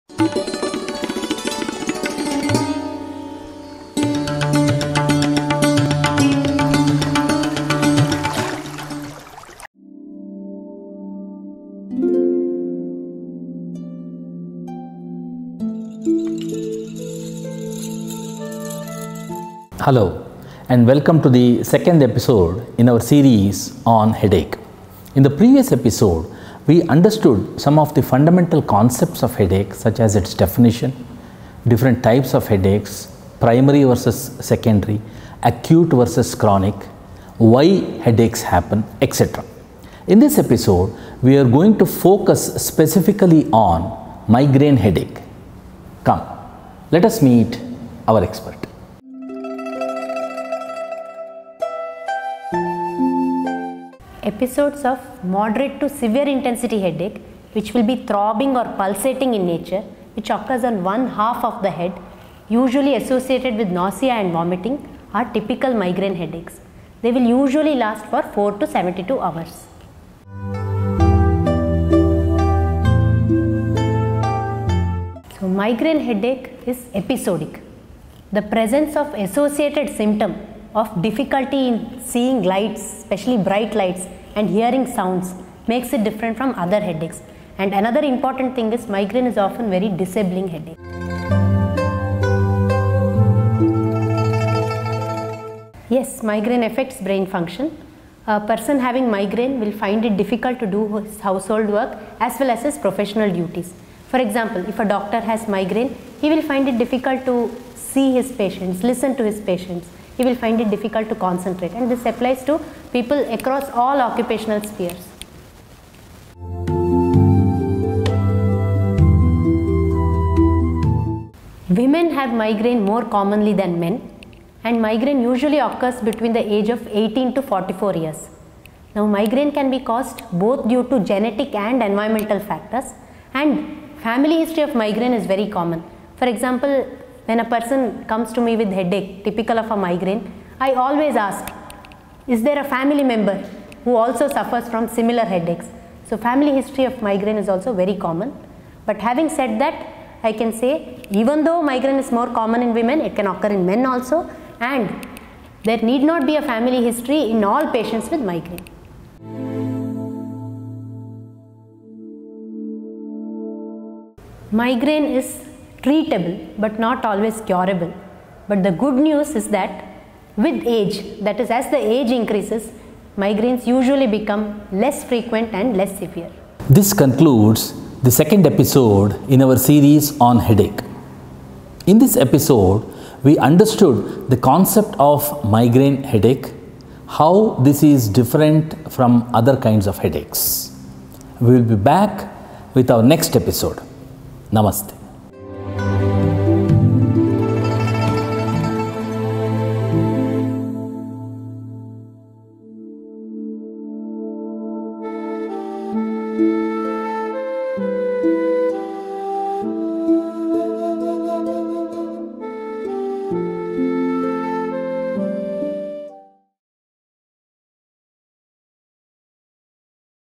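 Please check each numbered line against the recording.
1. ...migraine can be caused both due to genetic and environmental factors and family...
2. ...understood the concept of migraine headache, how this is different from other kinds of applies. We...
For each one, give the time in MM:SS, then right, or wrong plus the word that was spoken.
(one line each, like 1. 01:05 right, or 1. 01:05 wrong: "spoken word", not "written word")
1. 02:09 right
2. 03:03 wrong: "headaches", not "applies".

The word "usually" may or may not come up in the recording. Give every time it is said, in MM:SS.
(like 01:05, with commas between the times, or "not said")
01:02, 01:07, 02:05, 02:53.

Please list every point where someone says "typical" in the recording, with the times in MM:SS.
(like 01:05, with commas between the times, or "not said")
01:05, 02:19.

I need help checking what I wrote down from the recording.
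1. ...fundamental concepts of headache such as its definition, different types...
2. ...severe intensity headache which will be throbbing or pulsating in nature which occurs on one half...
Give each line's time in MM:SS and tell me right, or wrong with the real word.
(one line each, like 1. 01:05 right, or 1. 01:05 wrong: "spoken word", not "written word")
1. 00:28 right
2. 00:55 right.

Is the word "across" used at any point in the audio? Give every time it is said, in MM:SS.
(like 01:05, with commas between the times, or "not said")
01:53.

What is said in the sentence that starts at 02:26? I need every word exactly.
So family history of migraine is also very common.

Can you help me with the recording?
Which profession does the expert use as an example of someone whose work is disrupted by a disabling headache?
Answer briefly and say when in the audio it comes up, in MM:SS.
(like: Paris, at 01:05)
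Doctor, at 01:44.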